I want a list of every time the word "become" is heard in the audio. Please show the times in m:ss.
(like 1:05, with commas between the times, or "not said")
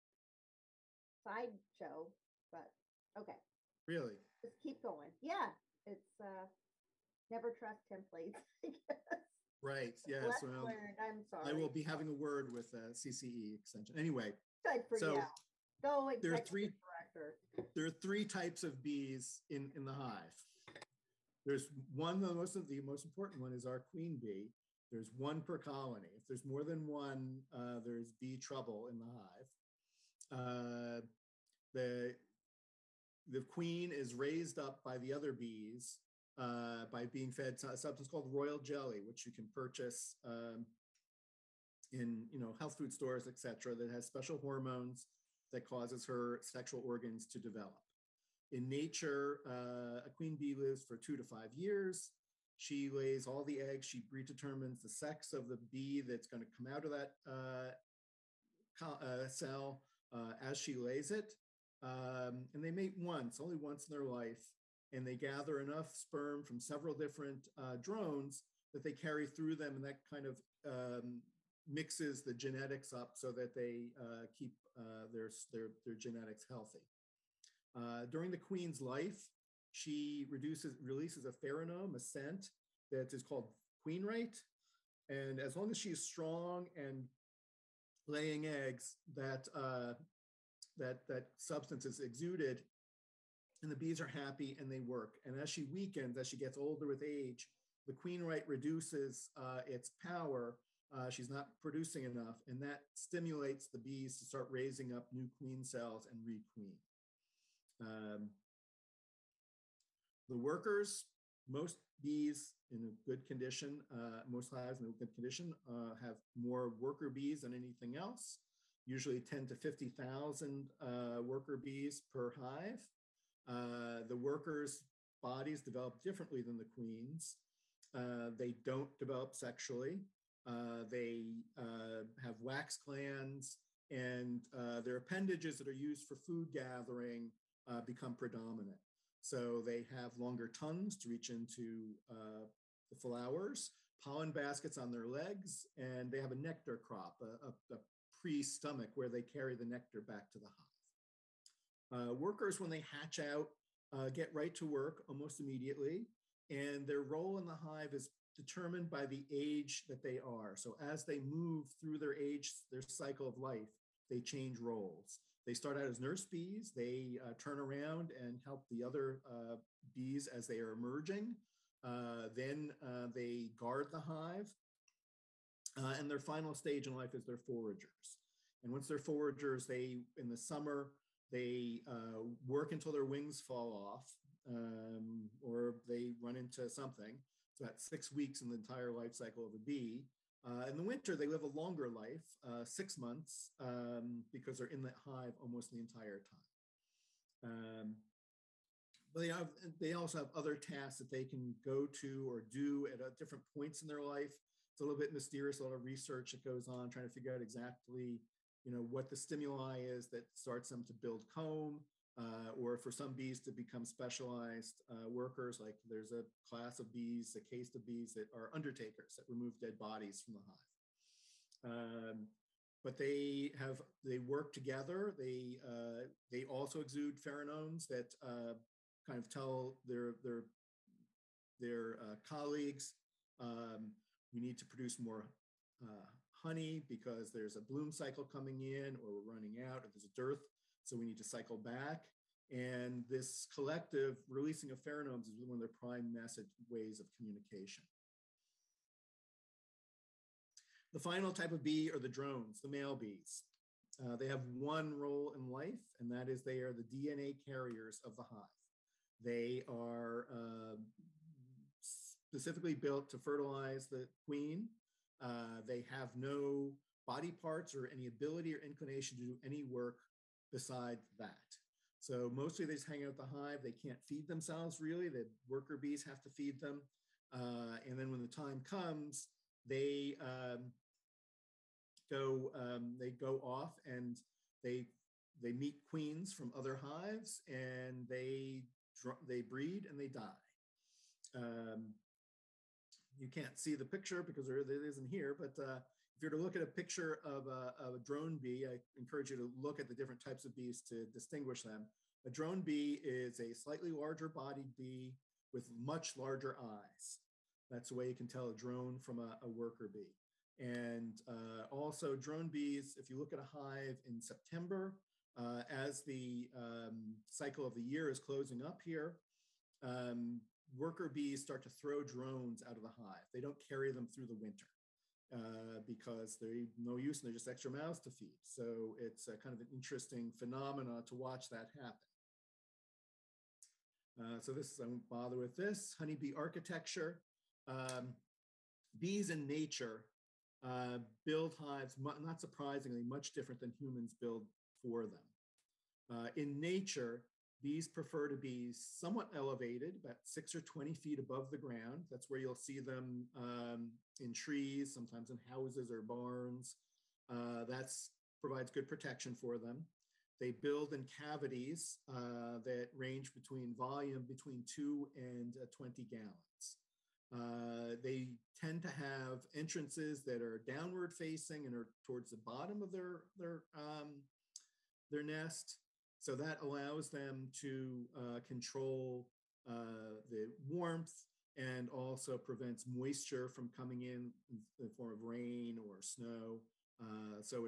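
2:17, 3:33.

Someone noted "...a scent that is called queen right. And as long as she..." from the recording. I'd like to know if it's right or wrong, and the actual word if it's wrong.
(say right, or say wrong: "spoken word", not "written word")
right.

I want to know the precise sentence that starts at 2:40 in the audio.
So as they move through their age, their cycle of life, they change roles.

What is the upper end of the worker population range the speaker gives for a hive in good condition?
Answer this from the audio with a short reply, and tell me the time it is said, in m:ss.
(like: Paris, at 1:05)
50,000, at 1:59.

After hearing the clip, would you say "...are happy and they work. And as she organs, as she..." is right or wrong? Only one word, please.
wrong.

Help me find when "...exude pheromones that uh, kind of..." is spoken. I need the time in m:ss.
3:46.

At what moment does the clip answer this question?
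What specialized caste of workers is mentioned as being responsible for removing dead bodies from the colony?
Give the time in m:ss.
3:38.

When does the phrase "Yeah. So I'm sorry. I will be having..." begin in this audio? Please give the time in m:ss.
0:10.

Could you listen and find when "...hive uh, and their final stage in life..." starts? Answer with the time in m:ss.
2:54.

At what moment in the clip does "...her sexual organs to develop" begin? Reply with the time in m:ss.
0:46.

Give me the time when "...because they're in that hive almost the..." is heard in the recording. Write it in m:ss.
3:14.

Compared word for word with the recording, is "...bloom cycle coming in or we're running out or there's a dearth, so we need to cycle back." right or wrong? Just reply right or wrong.
right.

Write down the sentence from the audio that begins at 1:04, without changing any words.
And they gather enough sperm from several different uh, drones that they carry through them.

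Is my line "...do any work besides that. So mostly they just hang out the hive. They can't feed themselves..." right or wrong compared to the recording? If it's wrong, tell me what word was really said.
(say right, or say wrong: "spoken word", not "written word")
right.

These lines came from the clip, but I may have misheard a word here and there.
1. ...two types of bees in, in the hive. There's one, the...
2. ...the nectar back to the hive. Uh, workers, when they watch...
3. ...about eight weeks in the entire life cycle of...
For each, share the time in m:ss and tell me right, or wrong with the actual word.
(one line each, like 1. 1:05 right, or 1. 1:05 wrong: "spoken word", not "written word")
1. 0:17 wrong: "three", not "two"
2. 2:29 wrong: "hatch", not "watch"
3. 3:07 wrong: "six", not "eight".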